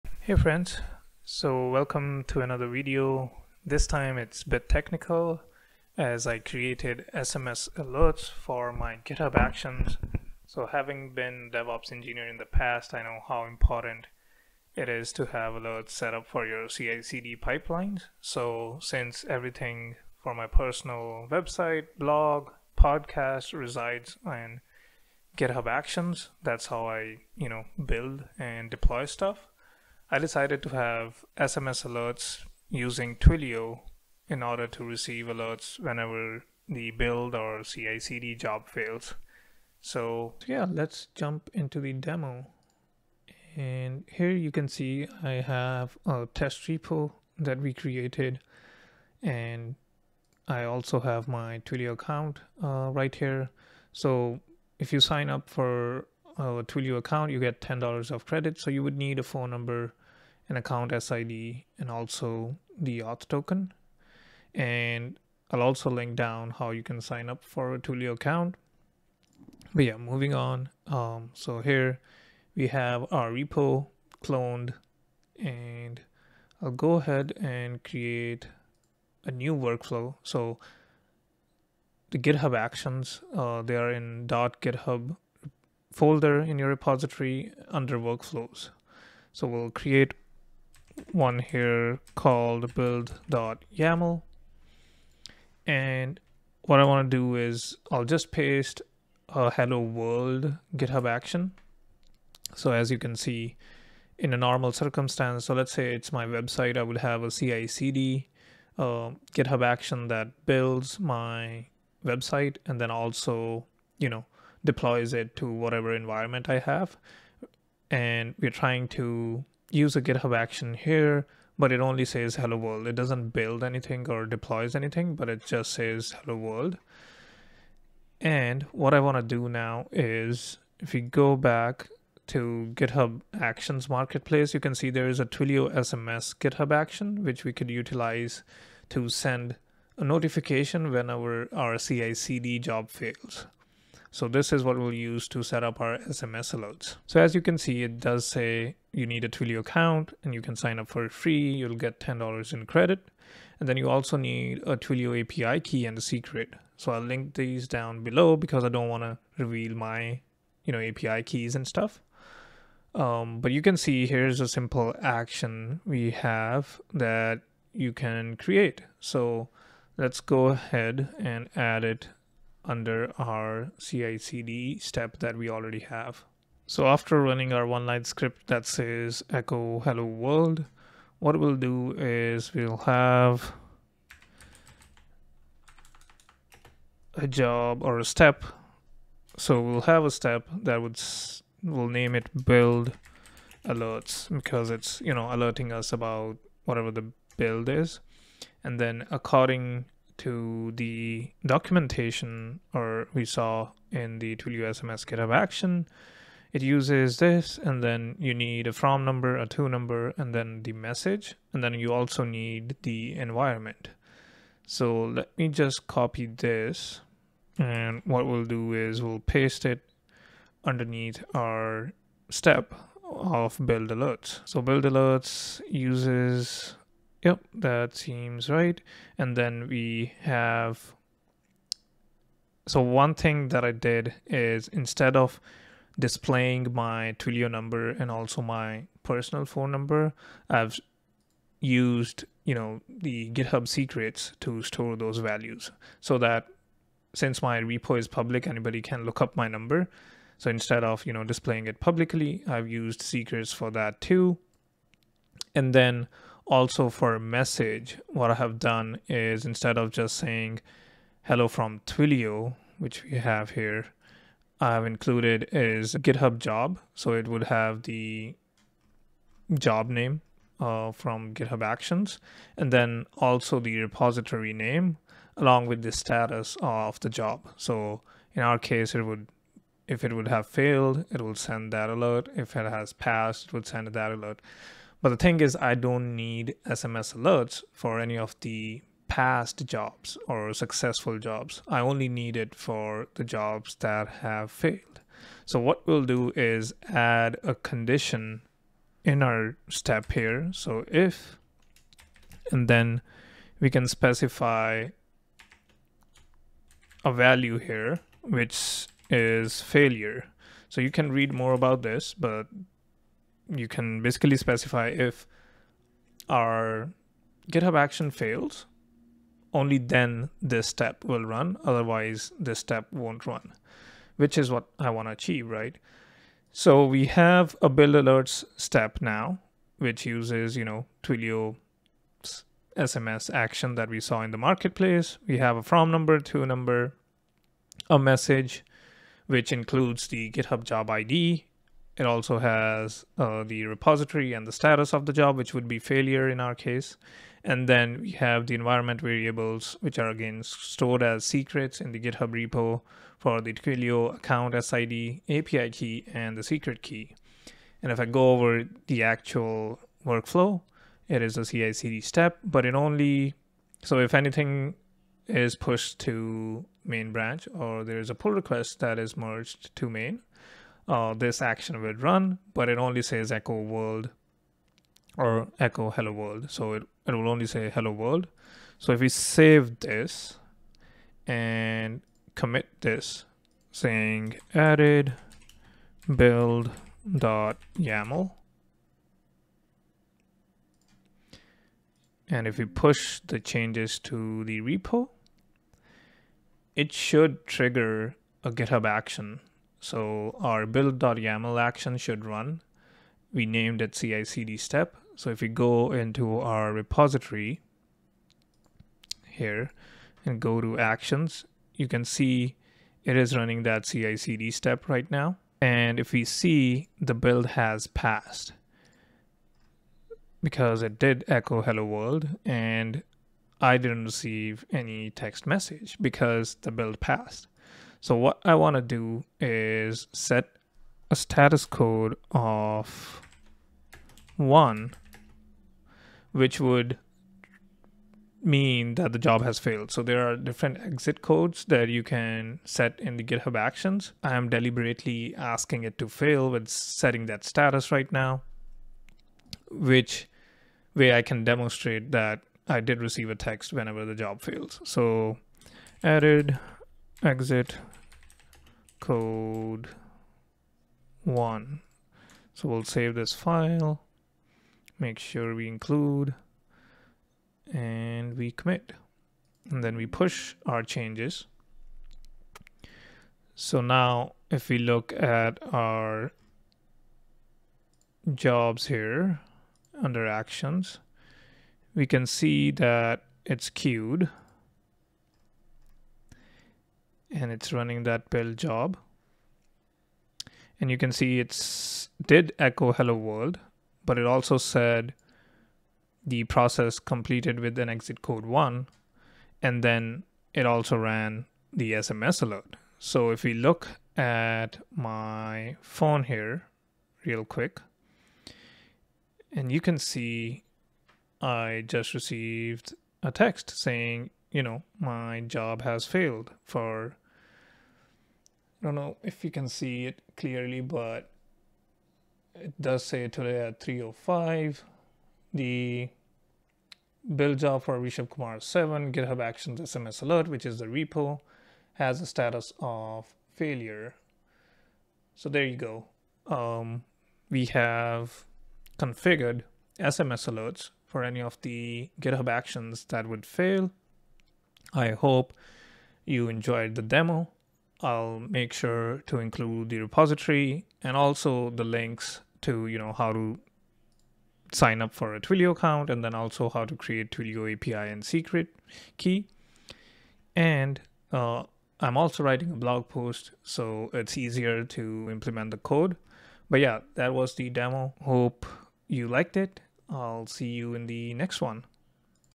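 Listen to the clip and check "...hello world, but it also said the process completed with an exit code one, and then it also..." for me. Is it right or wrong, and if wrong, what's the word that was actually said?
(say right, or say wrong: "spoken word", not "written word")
right.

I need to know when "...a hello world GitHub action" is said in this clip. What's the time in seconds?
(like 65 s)
99 s.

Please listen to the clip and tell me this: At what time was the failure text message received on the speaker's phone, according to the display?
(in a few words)
3:05.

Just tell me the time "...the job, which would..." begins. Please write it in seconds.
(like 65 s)
345 s.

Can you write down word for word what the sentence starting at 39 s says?
So yeah, let's jump into the demo.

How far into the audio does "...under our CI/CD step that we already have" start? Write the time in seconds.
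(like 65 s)
172 s.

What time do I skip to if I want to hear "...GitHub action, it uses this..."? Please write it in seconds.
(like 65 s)
205 s.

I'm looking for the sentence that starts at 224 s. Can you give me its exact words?
So build alerts uses Yep, that seems right.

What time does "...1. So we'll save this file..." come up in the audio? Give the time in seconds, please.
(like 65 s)
461 s.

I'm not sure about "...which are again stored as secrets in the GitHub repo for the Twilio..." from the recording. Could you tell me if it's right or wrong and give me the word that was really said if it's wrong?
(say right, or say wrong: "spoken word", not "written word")
right.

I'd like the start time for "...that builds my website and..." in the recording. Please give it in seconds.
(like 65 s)
110 s.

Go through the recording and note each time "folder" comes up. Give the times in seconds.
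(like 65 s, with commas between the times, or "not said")
85 s.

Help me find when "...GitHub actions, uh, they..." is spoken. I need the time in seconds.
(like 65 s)
82 s.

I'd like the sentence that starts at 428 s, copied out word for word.
So what I want to do is set a status code of 1, which would mean that the job has failed.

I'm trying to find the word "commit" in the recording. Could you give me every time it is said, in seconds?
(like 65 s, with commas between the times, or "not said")
382 s, 468 s.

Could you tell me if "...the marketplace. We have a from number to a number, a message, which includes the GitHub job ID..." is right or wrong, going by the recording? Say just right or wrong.
right.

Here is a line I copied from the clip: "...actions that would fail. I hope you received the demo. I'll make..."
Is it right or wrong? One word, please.
wrong.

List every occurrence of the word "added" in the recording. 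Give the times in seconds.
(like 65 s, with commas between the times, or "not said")
384 s, 456 s.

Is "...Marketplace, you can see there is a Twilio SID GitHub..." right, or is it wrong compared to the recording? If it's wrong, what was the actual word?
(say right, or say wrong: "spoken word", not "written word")
wrong: "SMS", not "SID".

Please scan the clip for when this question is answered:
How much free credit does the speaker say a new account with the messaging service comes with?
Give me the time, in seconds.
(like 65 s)
57 s.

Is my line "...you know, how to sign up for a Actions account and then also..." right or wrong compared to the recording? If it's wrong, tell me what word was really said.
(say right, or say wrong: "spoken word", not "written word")
wrong: "Twilio", not "Actions".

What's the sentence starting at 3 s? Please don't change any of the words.
This time it's a bit technical as I created SMS alerts for my GitHub Actions.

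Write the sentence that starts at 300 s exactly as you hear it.
So if, and then we can specify a value here, which is failure.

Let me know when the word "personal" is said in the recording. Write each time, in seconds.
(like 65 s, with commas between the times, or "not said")
20 s, 239 s.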